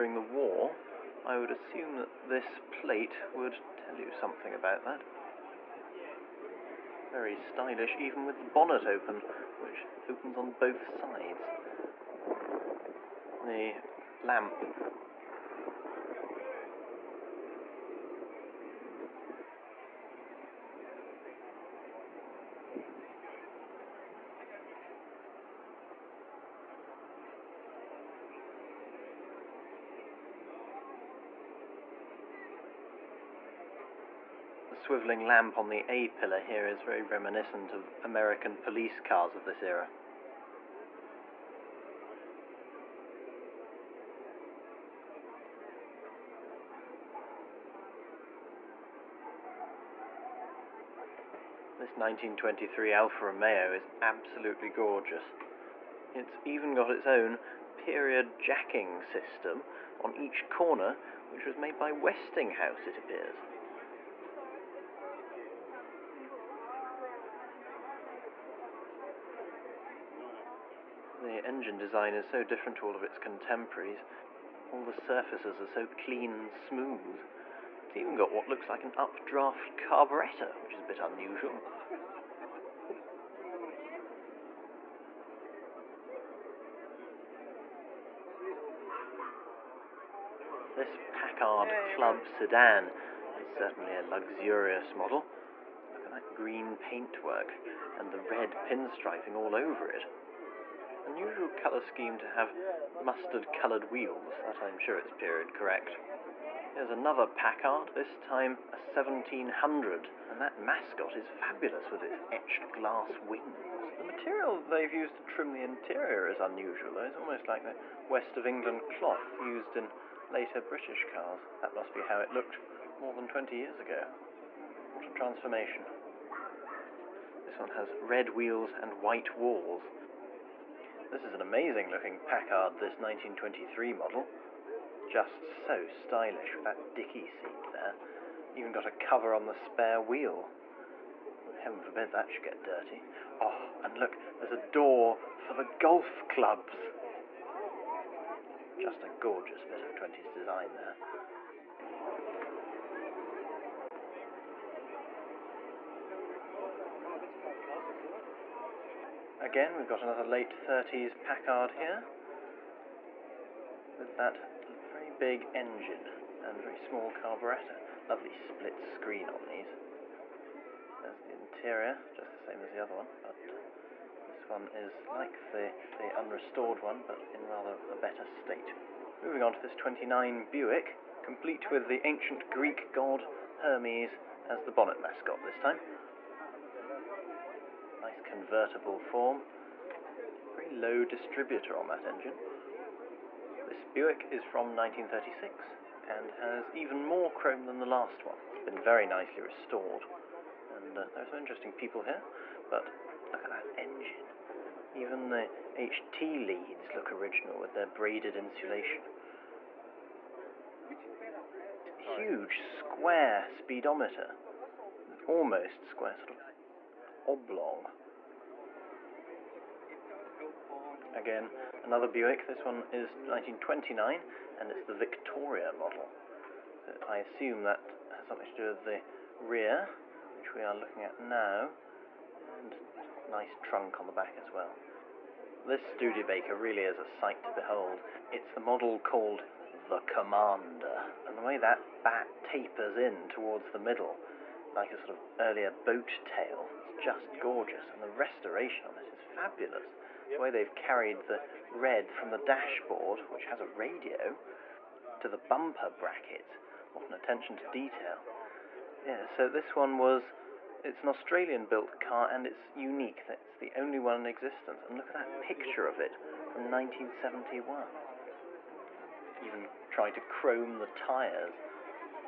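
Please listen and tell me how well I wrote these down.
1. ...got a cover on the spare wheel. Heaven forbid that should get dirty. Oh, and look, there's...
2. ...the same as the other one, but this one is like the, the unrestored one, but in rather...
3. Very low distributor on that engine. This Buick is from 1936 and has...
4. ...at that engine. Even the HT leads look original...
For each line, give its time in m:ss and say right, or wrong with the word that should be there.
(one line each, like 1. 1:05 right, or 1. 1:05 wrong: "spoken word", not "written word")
1. 2:18 right
2. 2:52 right
3. 3:10 right
4. 3:23 right.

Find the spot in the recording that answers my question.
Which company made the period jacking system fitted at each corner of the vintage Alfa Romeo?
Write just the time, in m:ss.
1:01.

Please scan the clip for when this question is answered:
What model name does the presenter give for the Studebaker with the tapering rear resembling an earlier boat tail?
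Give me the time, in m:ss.
3:59.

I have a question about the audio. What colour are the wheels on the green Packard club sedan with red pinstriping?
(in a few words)
Mustard.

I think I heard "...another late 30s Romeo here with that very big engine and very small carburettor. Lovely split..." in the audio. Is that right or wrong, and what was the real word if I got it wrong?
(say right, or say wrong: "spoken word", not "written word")
wrong: "Packard", not "Romeo".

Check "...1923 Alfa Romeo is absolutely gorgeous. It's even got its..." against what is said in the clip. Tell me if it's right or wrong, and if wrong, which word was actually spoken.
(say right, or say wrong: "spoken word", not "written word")
right.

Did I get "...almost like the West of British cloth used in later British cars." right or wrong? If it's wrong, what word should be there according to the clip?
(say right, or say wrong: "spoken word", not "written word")
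wrong: "England", not "British".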